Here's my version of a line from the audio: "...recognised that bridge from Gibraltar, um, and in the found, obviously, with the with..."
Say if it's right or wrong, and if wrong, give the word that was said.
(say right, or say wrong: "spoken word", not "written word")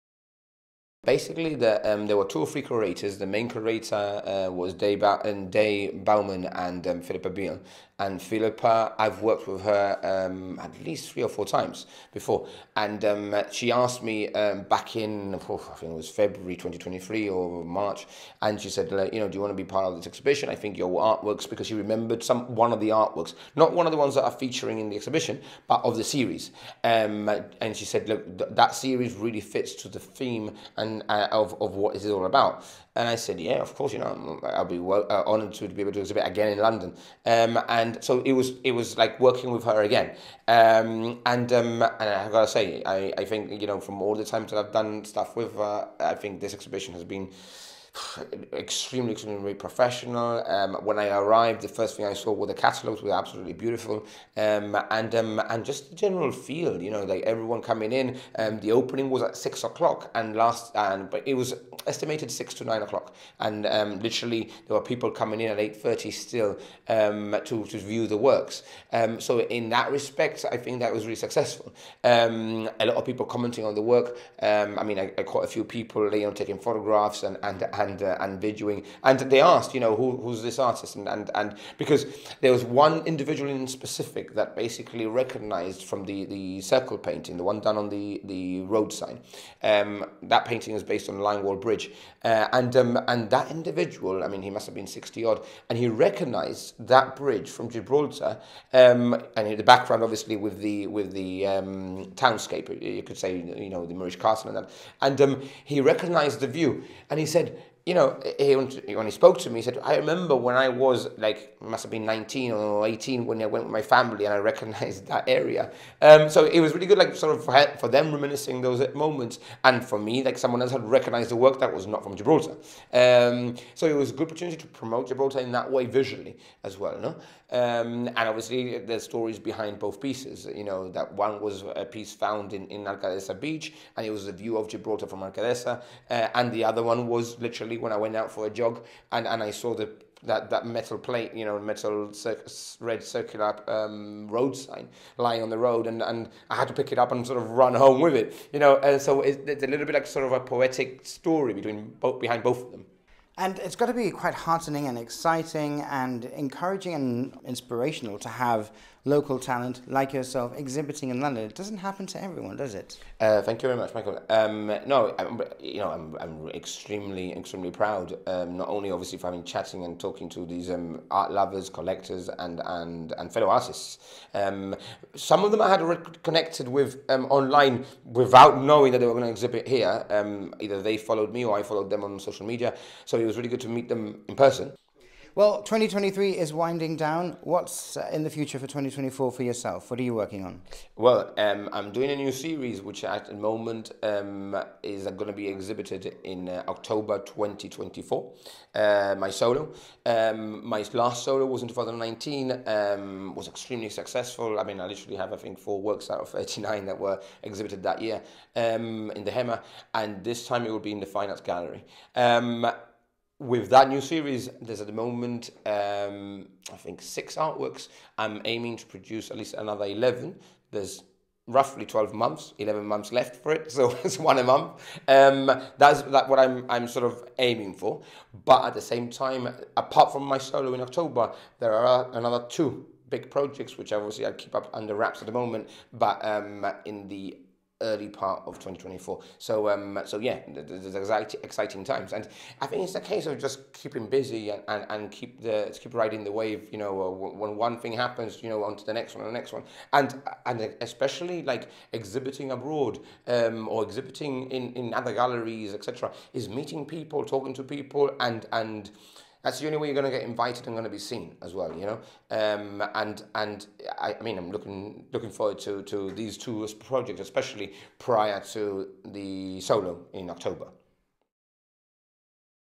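wrong: "background", not "found".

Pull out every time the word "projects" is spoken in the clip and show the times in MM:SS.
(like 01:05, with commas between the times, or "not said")
03:53, 04:26.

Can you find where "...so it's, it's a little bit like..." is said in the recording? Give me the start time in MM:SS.
02:29.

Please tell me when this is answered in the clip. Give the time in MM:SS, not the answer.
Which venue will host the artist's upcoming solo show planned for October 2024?
03:31.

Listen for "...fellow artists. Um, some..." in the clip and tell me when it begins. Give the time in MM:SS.
02:53.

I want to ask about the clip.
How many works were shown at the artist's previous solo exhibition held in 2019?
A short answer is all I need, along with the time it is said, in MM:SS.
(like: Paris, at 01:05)
39, at 03:26.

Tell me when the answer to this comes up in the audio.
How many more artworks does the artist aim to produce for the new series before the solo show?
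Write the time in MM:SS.
03:39.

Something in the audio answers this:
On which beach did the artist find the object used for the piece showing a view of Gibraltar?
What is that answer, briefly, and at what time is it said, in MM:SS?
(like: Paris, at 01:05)
Alcaidesa Beach, at 02:12.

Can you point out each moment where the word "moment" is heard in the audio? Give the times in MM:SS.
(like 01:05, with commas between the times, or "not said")
01:58, 03:13, 03:34, 03:55.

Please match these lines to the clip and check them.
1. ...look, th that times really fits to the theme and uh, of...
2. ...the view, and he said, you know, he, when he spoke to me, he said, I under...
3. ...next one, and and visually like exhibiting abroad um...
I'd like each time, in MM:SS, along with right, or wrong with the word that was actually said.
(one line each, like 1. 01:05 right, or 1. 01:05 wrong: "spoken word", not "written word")
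1. 00:28 wrong: "series", not "times"
2. 01:46 wrong: "remember", not "under"
3. 04:09 wrong: "especially", not "visually".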